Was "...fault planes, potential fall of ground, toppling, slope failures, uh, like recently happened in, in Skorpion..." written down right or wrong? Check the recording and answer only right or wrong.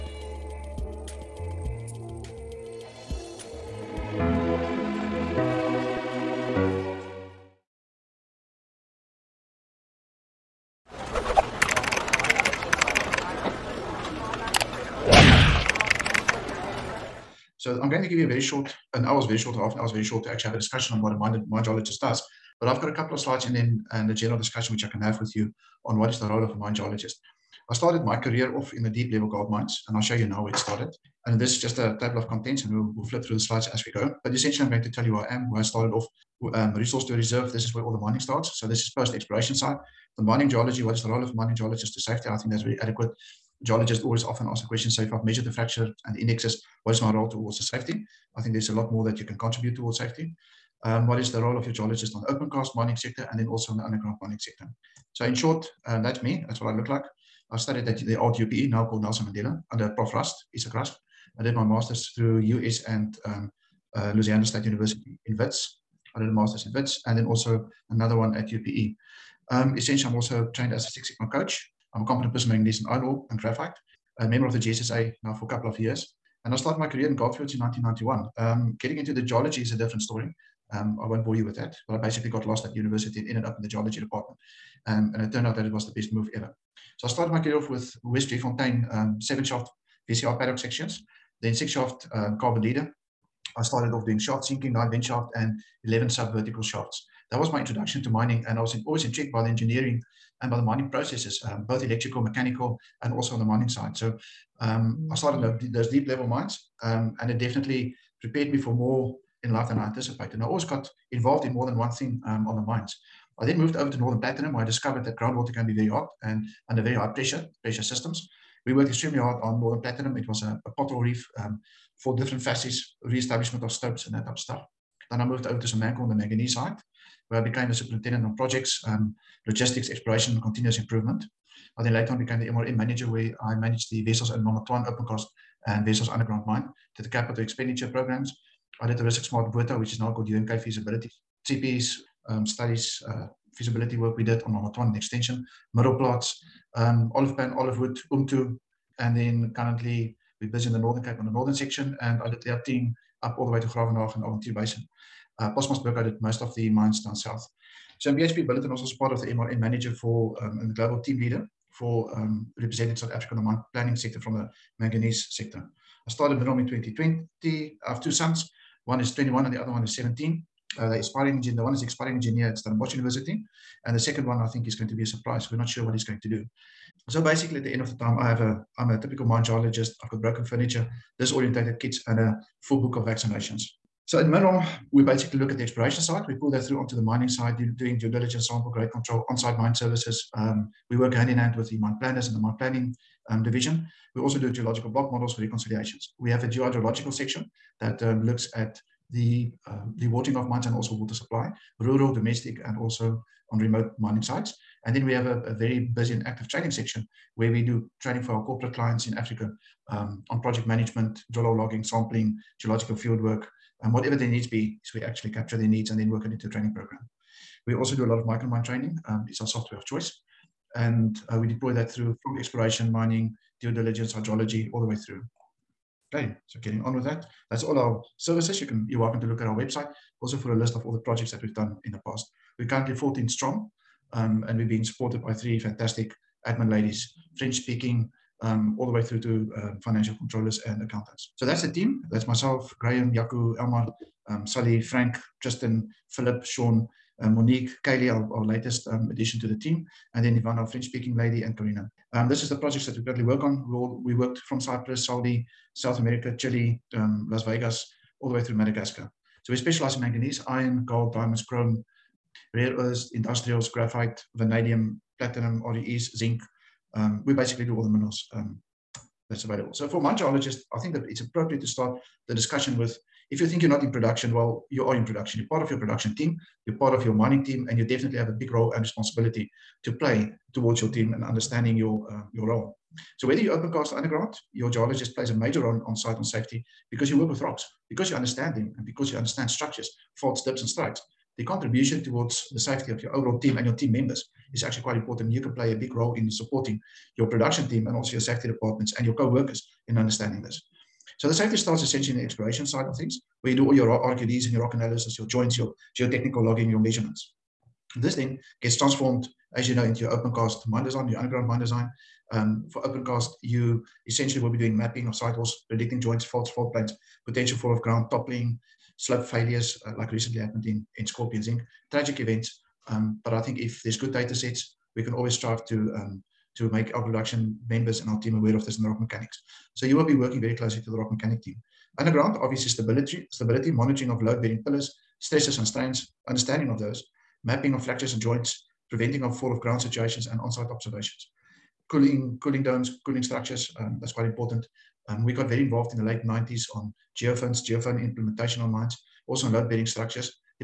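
right.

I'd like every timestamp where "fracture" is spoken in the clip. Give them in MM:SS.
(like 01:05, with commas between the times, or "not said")
00:45, 05:37.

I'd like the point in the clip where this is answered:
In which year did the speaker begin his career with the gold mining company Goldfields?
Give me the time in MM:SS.
01:17.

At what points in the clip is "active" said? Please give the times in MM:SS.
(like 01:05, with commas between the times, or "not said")
03:26.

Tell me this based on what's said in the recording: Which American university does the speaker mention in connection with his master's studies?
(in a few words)
Louisiana State University.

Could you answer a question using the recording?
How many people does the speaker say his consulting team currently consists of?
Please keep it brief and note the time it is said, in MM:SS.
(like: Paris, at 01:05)
14, at 03:52.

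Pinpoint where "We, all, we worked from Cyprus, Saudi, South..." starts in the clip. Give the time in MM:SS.
04:13.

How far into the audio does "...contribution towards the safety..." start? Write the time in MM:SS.
04:51.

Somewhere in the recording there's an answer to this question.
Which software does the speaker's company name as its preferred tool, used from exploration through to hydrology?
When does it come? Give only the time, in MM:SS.
03:38.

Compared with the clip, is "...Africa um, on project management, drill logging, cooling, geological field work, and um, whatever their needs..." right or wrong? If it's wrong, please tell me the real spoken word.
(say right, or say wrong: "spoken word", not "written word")
wrong: "sampling", not "cooling".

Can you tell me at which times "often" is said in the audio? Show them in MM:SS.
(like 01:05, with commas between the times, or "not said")
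00:44.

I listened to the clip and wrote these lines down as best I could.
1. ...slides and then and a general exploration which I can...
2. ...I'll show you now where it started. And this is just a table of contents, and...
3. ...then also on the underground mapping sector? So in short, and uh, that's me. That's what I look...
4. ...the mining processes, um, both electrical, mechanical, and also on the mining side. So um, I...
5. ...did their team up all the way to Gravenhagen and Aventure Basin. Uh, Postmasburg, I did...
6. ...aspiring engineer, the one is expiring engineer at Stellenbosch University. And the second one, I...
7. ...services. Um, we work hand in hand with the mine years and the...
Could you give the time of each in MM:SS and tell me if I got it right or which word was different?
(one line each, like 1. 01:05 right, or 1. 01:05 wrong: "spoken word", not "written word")
1. 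00:23 wrong: "discussion", not "exploration"
2. 00:29 right
3. 00:53 wrong: "mining", not "mapping"
4. 01:40 right
5. 02:32 right
6. 02:50 right
7. 03:09 wrong: "planners", not "years".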